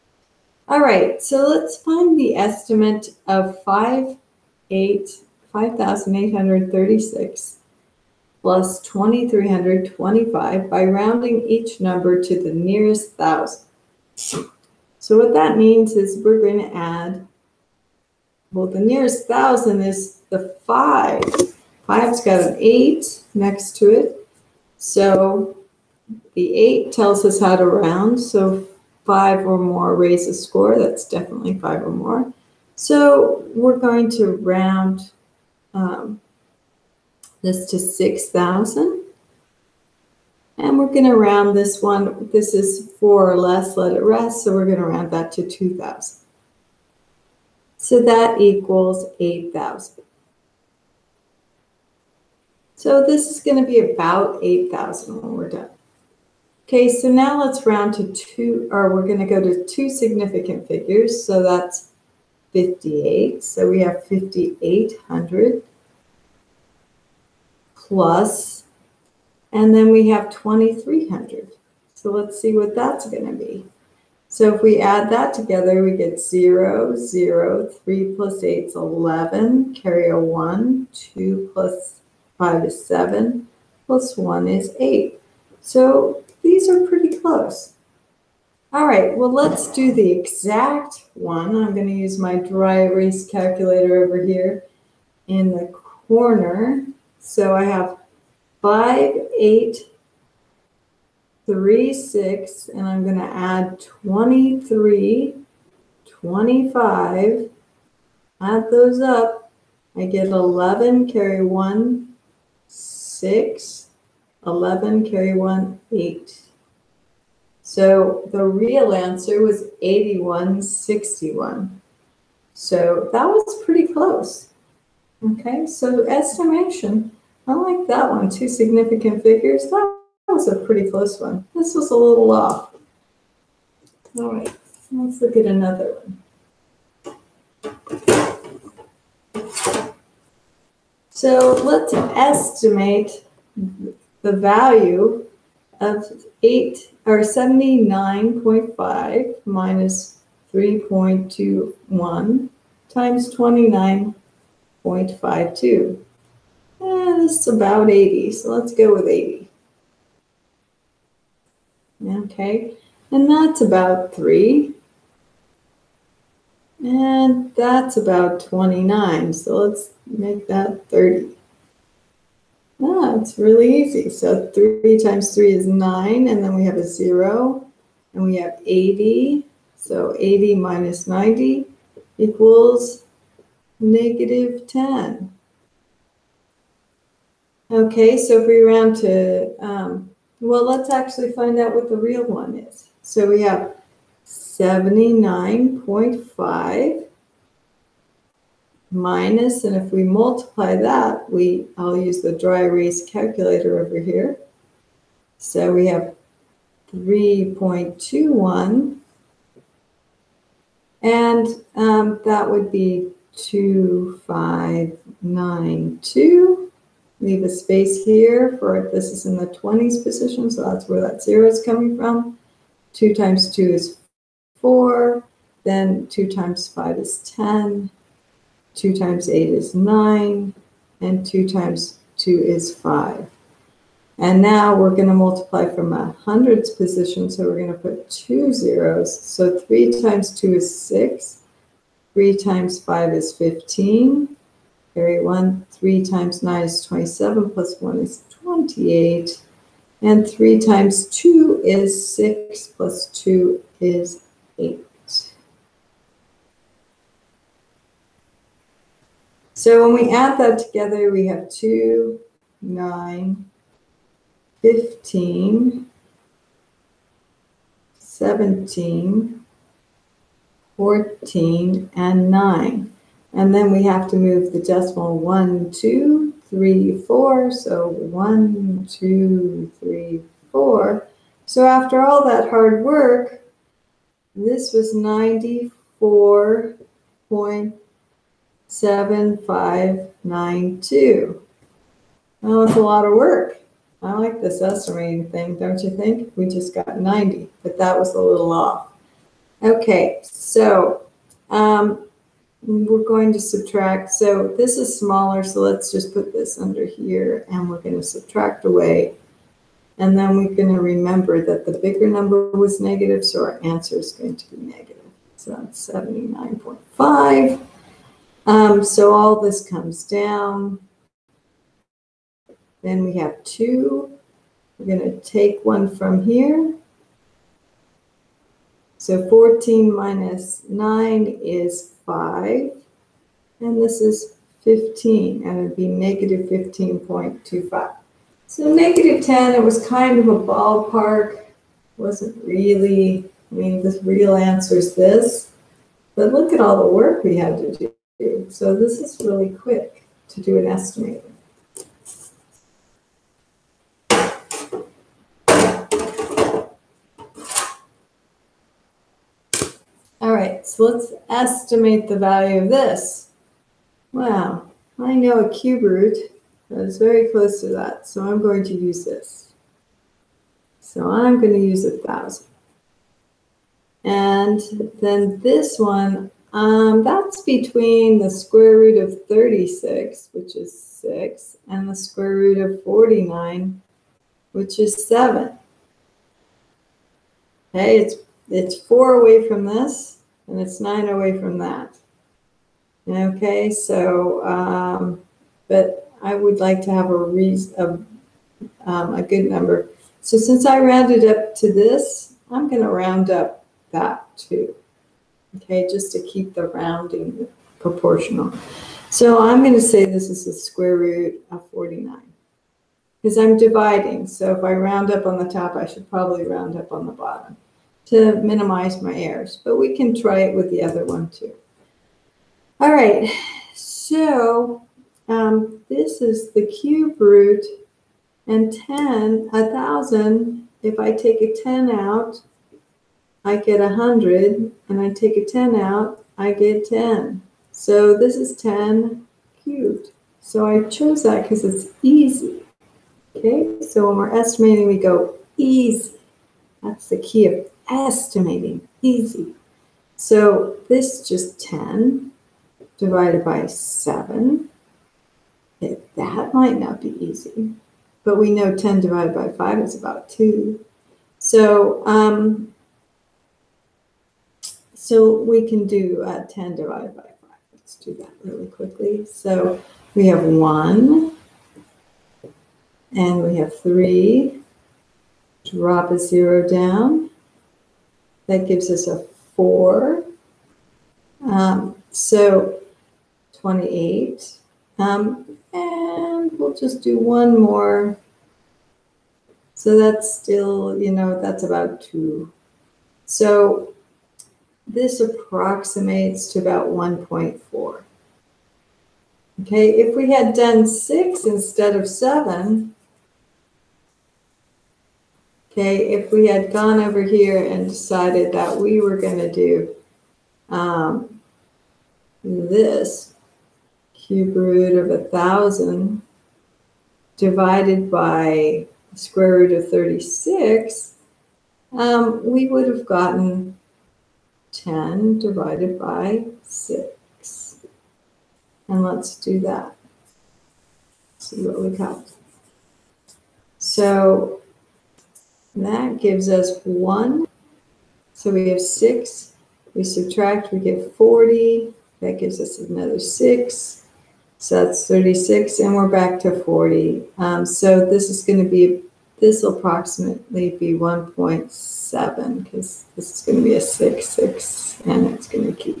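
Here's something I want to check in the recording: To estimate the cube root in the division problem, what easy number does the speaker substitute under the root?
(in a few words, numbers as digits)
1,000.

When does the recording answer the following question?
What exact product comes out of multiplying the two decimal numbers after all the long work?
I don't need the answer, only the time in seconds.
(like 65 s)
284 s.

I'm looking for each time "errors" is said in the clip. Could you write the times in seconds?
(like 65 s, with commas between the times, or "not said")
419 s.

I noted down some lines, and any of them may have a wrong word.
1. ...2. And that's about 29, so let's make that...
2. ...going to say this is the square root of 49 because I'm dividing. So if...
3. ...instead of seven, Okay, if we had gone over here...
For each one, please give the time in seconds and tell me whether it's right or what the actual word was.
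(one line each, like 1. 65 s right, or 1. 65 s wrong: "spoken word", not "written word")
1. 164 s wrong: "3", not "2"
2. 409 s right
3. 501 s right.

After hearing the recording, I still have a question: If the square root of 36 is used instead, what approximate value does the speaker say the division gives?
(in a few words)
1.7.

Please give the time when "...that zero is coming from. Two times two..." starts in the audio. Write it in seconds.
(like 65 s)
221 s.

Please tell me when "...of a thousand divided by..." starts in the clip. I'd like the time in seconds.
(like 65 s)
514 s.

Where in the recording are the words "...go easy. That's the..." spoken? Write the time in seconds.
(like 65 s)
444 s.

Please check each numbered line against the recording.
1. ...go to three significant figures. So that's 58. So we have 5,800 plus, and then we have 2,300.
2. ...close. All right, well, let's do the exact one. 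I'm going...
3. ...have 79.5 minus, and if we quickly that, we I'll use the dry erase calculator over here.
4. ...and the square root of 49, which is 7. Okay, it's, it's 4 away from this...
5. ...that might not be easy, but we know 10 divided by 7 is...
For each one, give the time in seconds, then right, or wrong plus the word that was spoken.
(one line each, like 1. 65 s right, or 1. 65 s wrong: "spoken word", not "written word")
1. 59 s wrong: "two", not "three"
2. 87 s right
3. 193 s wrong: "multiply", not "quickly"
4. 381 s right
5. 456 s wrong: "5", not "7".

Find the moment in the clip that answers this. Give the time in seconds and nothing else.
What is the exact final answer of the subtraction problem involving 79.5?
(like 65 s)
335 s.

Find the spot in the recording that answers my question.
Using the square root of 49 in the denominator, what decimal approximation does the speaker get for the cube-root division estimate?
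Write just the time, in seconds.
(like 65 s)
496 s.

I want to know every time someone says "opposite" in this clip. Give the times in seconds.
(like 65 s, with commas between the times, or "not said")
not said.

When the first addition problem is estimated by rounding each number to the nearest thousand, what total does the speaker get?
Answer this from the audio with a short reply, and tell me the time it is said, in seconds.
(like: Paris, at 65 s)
8,000, at 47 s.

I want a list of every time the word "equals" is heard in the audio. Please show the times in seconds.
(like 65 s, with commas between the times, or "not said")
48 s, 182 s.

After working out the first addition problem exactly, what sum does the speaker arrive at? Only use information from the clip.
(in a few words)
8161.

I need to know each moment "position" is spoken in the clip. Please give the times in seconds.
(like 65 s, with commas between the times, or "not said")
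220 s, 236 s.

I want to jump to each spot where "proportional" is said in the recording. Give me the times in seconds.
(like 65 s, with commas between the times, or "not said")
407 s.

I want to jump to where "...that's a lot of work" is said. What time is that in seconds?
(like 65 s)
292 s.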